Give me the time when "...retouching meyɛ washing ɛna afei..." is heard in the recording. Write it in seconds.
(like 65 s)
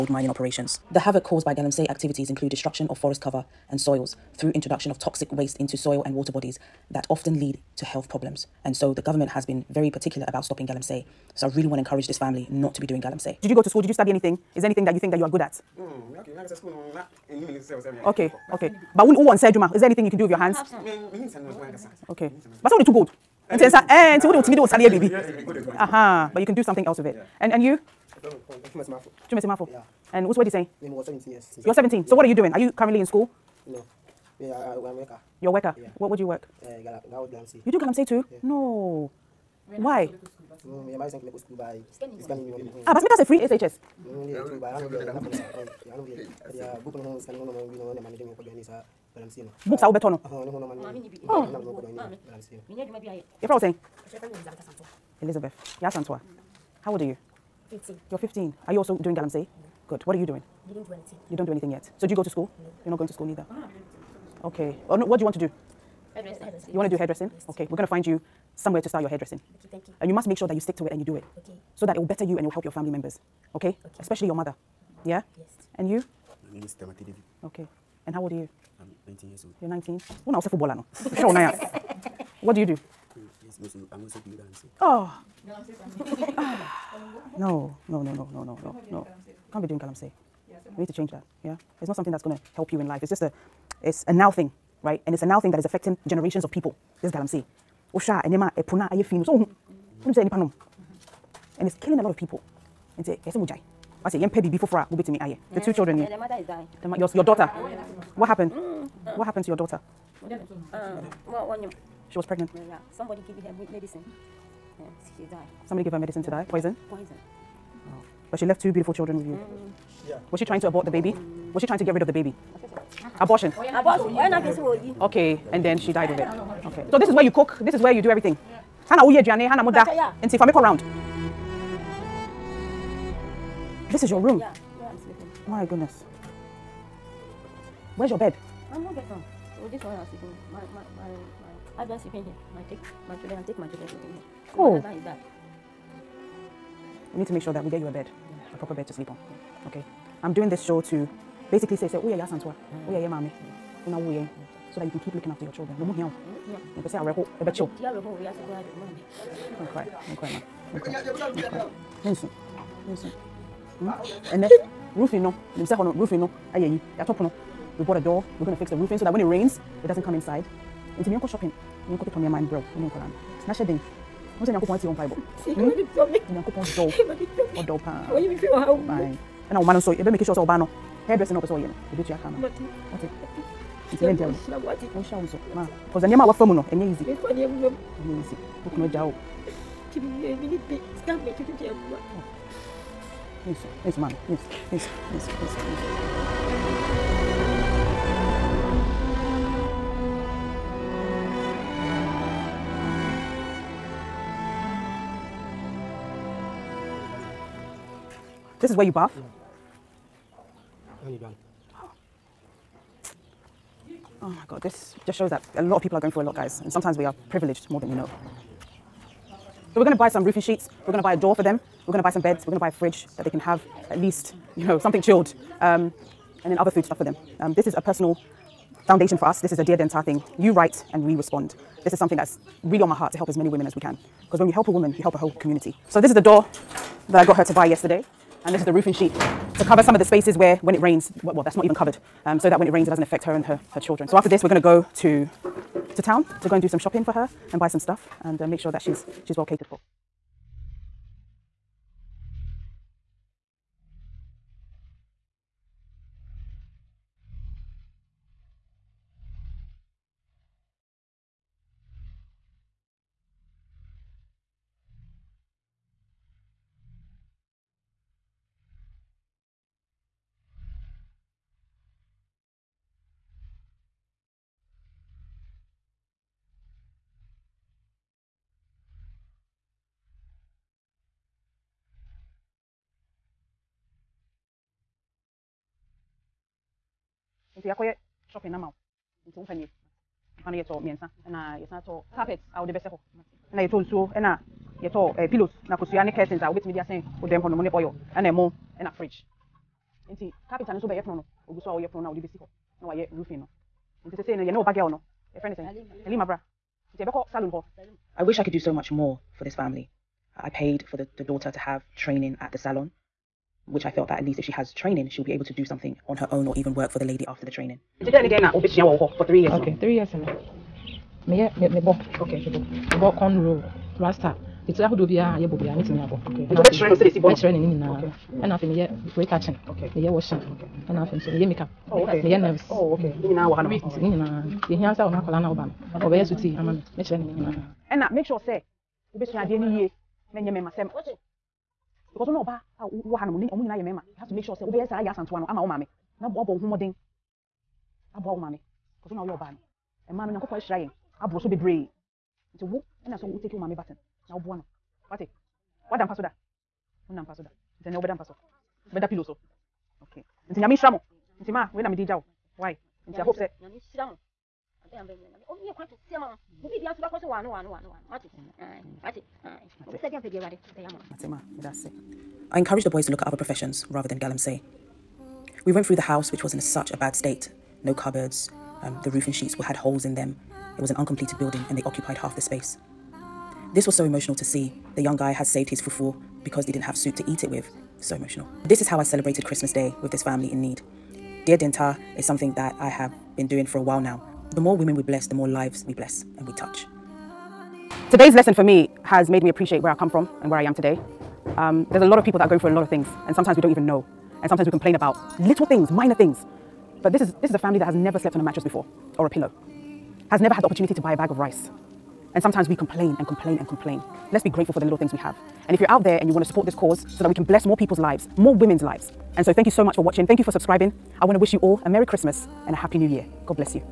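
329 s.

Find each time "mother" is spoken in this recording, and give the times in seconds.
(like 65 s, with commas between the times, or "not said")
74 s, 106 s.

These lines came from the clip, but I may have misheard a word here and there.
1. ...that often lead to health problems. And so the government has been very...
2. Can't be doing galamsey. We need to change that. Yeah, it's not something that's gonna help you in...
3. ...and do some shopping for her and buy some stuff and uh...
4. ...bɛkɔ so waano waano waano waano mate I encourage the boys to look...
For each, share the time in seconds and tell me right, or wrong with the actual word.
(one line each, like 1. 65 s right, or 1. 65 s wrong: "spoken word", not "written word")
1. 6 s right
2. 89 s right
3. 246 s right
4. 367 s right.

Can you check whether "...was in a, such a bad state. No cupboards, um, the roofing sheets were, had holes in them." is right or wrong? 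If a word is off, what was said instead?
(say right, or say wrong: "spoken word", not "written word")
right.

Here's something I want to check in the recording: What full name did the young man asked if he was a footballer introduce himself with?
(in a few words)
Tamati David.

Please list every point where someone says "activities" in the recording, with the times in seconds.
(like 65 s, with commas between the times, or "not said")
1 s.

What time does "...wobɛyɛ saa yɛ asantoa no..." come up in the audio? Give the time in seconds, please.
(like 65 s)
344 s.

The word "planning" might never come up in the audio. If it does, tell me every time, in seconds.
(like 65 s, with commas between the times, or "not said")
not said.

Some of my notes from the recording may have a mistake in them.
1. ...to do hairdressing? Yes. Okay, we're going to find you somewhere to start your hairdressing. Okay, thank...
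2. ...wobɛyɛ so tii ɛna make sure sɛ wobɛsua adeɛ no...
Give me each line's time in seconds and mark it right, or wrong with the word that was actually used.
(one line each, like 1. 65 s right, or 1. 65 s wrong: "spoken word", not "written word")
1. 66 s right
2. 336 s wrong: "ɔbɛyɛ", not "wobɛyɛ".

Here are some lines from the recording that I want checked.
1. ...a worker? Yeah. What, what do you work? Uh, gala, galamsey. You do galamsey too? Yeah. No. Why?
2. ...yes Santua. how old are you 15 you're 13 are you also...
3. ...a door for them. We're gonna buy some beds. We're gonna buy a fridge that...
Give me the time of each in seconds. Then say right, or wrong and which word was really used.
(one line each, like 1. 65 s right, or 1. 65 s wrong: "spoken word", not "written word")
1. 35 s right
2. 55 s wrong: "15", not "13"
3. 221 s right.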